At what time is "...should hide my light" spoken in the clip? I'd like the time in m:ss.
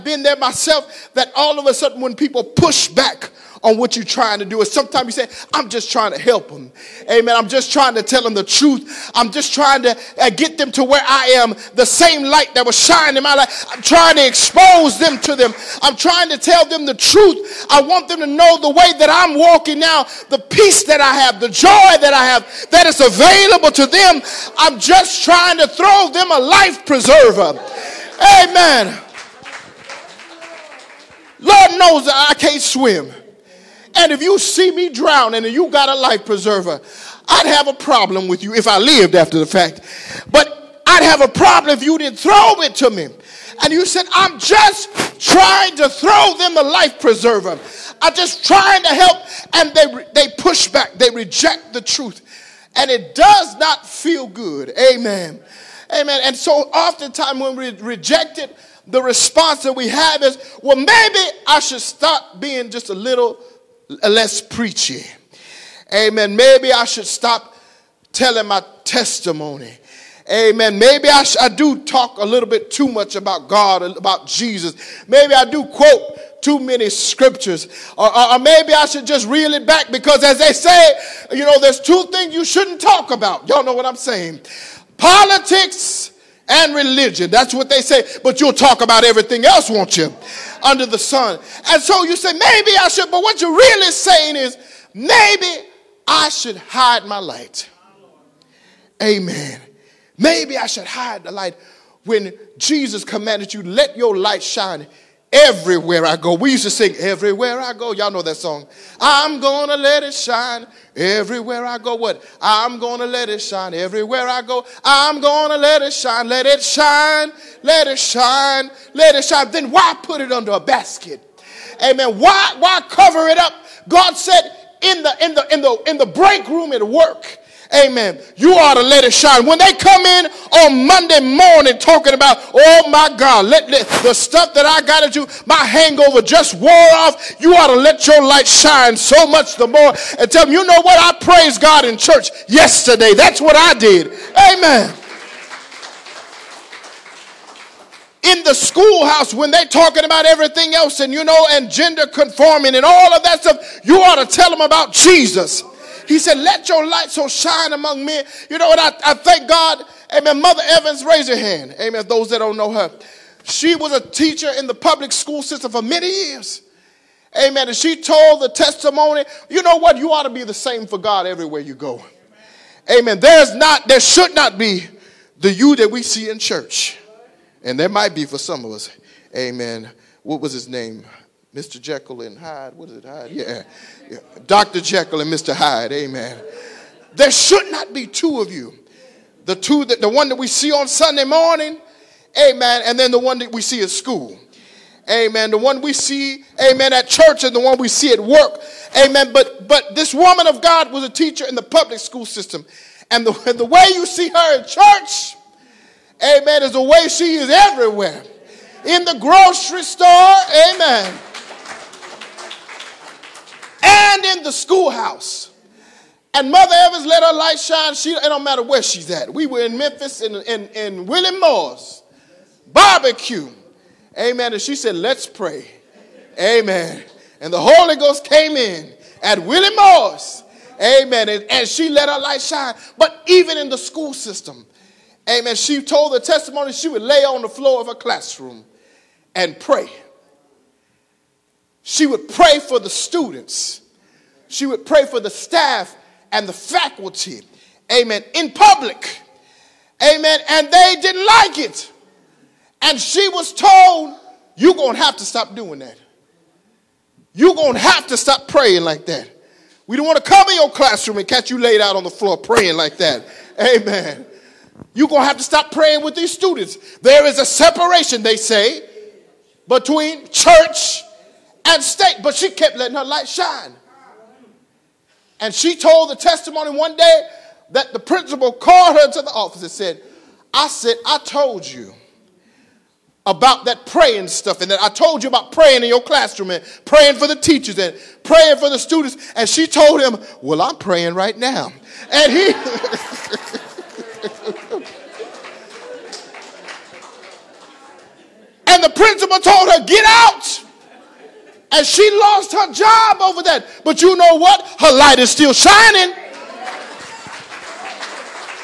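1:36.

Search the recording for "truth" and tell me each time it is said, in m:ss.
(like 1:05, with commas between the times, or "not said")
0:08, 0:16, 0:51.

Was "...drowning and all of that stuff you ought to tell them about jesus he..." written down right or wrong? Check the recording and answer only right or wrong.
wrong.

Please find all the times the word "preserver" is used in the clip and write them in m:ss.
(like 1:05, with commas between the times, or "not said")
0:26, 0:36, 0:47.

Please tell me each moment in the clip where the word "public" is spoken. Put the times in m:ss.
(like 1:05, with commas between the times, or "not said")
2:44, 3:21, 4:08.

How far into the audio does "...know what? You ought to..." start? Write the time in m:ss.
2:49.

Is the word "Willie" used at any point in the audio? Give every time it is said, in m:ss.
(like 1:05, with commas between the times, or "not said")
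3:41, 3:49.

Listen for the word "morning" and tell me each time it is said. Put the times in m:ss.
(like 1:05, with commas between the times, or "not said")
2:11, 3:11.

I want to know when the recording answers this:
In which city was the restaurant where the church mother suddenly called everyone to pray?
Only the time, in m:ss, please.
3:39.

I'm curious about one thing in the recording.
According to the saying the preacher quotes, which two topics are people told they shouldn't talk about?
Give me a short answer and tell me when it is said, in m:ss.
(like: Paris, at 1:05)
Politics and religion, at 1:24.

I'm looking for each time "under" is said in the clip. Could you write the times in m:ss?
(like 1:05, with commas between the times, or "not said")
1:30, 2:00.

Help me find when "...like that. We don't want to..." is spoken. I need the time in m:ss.
4:18.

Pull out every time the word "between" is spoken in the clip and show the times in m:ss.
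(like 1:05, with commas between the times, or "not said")
4:29.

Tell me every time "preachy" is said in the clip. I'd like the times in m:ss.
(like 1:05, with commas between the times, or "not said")
1:04.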